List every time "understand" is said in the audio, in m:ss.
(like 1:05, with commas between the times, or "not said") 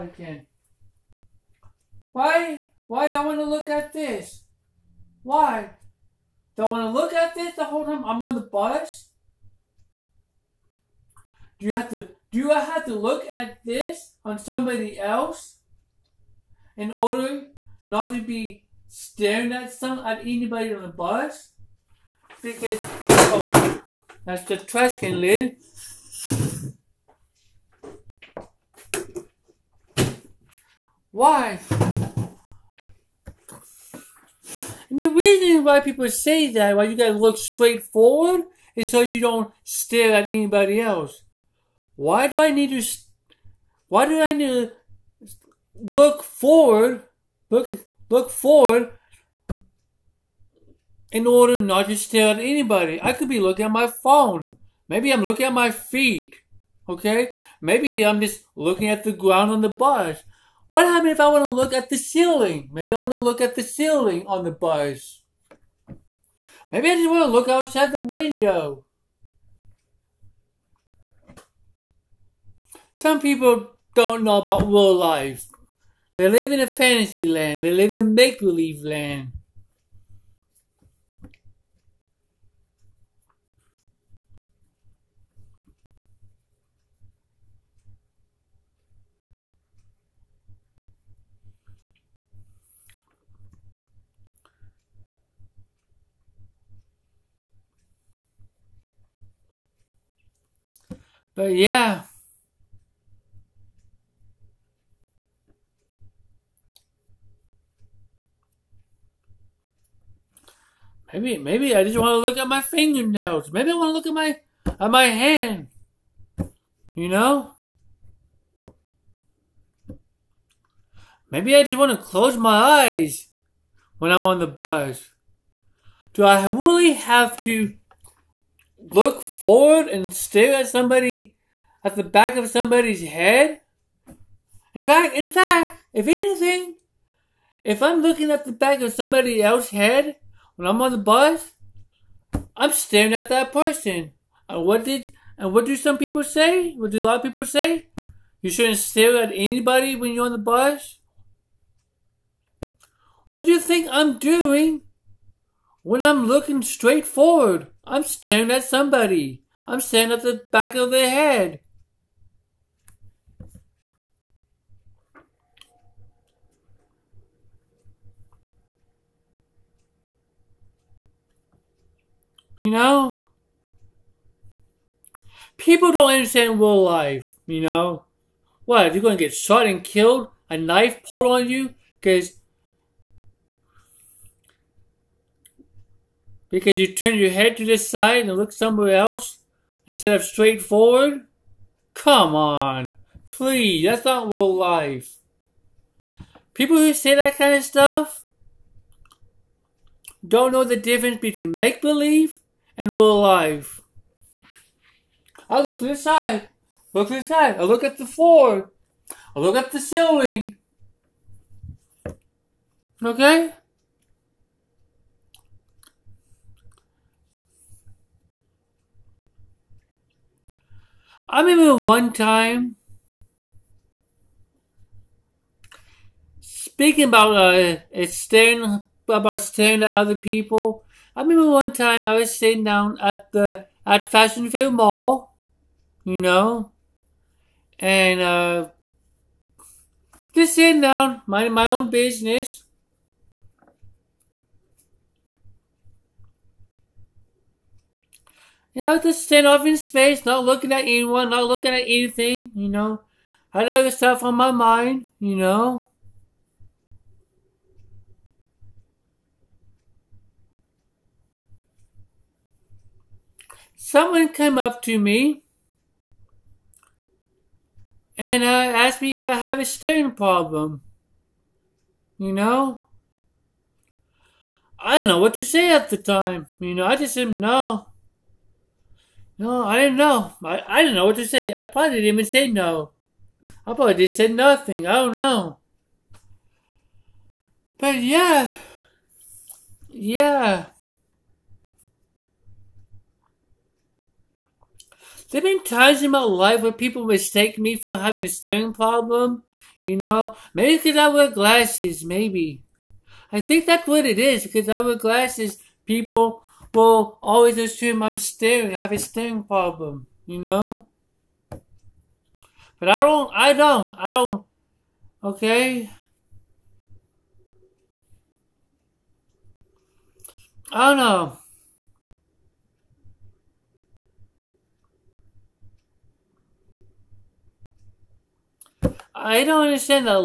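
2:56, 5:29.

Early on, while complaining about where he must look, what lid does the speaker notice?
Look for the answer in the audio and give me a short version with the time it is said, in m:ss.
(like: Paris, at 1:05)
Trash can lid, at 0:24.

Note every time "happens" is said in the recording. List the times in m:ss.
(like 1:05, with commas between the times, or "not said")
1:00.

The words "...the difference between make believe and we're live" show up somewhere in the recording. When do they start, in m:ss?
3:20.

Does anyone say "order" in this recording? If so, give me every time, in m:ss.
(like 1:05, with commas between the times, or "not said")
0:16, 0:51.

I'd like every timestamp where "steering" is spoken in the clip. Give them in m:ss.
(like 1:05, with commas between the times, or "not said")
4:29, 4:58.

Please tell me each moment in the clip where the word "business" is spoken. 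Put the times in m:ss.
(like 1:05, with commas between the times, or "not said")
4:01.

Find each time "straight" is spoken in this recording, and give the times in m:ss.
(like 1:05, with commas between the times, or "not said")
0:37, 2:36, 3:10.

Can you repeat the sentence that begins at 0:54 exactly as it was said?
Maybe I'm looking at my feet.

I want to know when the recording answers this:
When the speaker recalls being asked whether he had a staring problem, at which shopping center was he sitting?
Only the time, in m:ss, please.
3:54.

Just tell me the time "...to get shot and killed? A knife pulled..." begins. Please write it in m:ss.
2:59.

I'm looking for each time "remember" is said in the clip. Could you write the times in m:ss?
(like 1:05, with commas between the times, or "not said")
3:41, 3:51.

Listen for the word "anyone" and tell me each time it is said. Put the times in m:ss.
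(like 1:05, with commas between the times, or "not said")
4:10.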